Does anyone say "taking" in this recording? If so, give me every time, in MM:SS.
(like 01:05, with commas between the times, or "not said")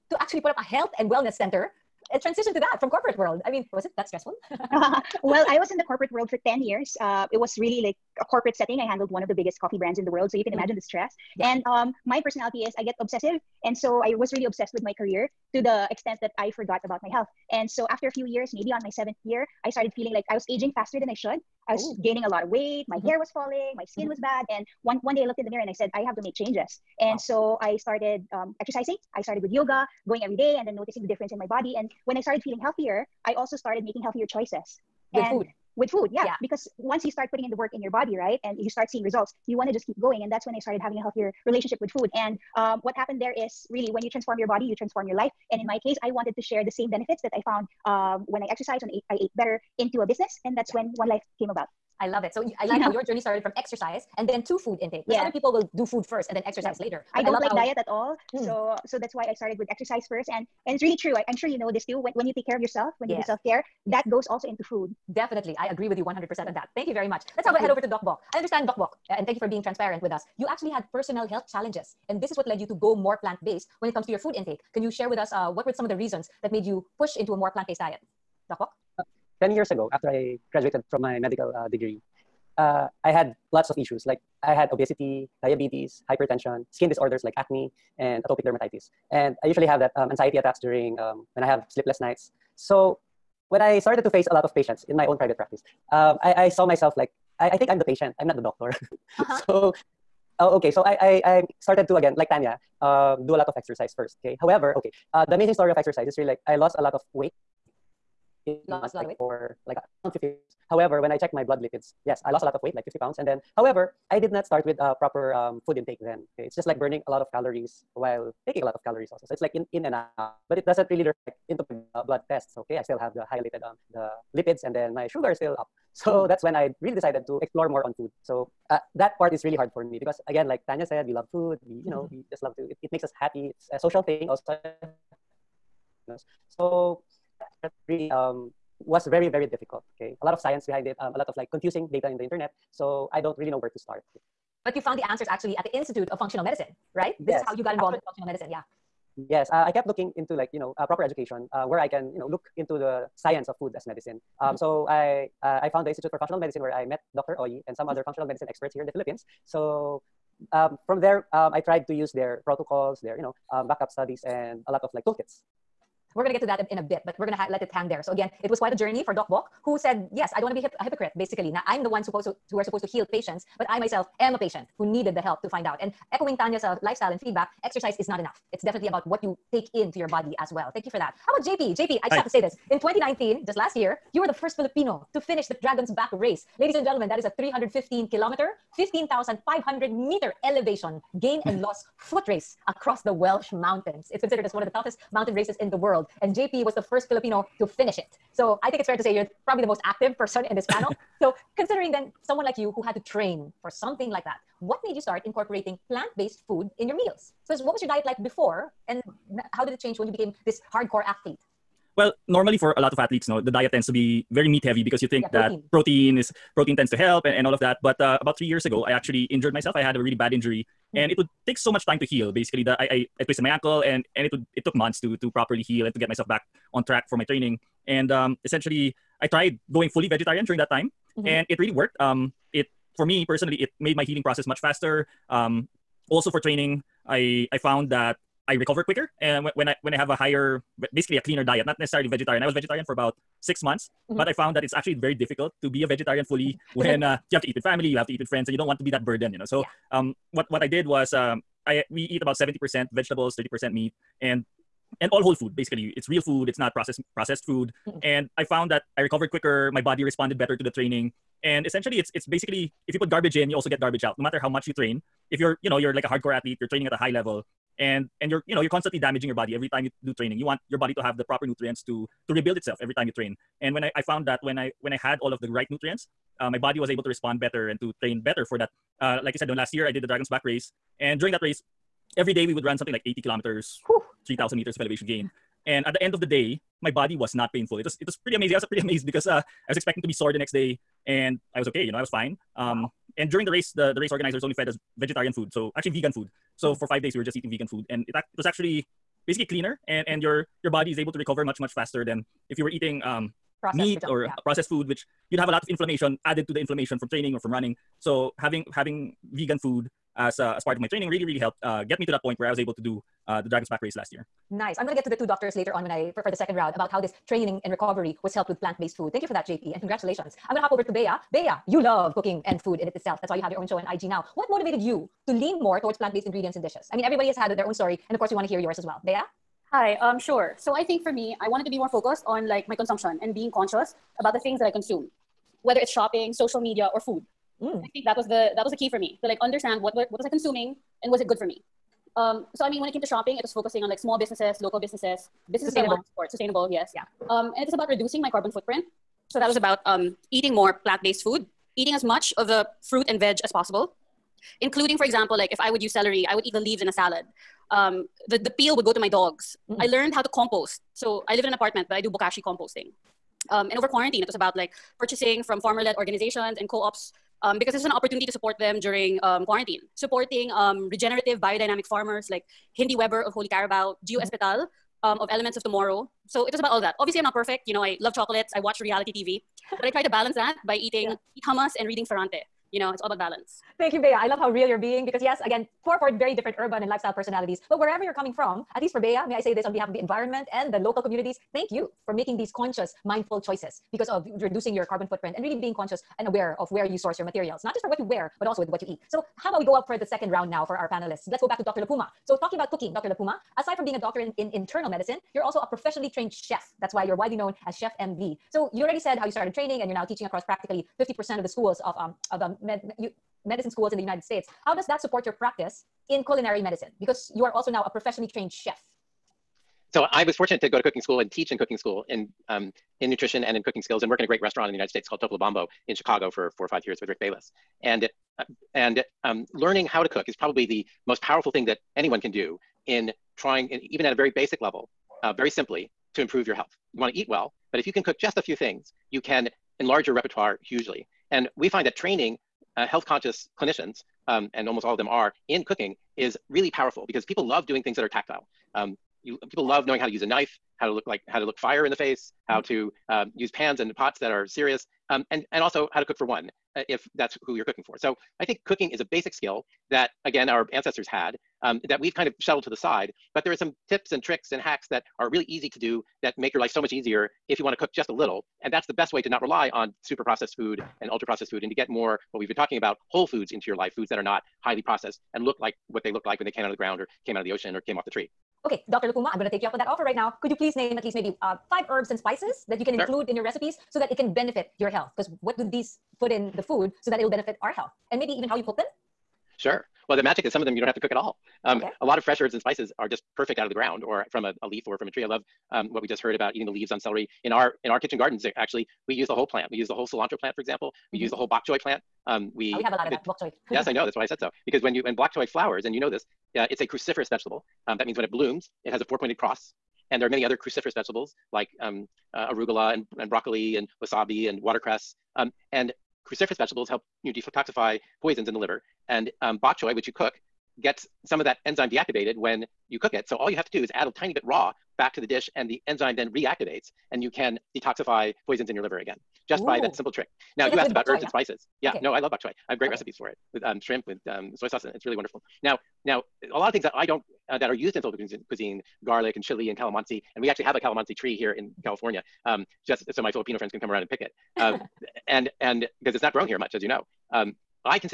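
01:58.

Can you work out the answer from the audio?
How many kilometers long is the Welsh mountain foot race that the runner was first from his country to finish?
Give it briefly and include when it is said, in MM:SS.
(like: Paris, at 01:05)
315 kilometers, at 03:07.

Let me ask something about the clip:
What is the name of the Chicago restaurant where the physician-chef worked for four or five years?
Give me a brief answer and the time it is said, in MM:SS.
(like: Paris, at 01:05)
Topolobampo, at 07:05.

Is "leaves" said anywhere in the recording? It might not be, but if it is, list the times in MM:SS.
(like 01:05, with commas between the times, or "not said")
05:56, 08:16.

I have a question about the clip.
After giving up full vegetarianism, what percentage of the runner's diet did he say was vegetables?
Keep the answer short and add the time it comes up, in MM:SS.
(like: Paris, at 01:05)
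70%, at 04:12.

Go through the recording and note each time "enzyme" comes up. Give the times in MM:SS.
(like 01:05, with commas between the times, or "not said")
08:41, 08:45.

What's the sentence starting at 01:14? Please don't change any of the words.
Can you share with us uh, what were some of the reasons that made you push into a more plant based diet?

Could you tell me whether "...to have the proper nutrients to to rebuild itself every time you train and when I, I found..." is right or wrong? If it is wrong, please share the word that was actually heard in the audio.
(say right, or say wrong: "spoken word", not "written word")
right.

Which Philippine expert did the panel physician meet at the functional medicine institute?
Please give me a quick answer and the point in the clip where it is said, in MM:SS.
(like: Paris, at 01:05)
Dr. Oyie, at 02:37.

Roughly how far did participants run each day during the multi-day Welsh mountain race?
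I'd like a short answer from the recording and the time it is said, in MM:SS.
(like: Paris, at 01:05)
80 kilometers, at 04:43.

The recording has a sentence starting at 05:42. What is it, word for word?
Um, so I mean, when it came to shopping, it was focusing on like small businesses, local businesses, businesses sustainable Sustainable, yes.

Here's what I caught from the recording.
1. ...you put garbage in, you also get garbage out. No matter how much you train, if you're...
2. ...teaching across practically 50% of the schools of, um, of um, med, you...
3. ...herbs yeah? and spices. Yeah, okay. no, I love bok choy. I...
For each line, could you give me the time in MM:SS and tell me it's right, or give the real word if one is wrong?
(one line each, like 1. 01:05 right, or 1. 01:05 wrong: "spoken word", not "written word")
1. 04:22 right
2. 06:50 right
3. 08:51 right.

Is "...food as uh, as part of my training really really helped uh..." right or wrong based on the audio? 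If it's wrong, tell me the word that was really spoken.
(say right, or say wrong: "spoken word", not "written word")
right.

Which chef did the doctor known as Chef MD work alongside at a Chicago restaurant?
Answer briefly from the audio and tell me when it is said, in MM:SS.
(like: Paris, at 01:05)
Rick Bayless, at 07:07.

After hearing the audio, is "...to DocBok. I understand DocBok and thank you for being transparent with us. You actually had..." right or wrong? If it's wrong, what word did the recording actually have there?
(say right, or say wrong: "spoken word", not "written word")
right.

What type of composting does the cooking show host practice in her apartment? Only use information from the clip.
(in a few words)
bokashi.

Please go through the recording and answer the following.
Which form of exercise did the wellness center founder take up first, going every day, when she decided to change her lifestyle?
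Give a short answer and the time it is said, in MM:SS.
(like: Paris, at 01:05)
yoga, at 00:29.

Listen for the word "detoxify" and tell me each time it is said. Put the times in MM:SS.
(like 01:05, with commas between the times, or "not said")
08:37, 08:47.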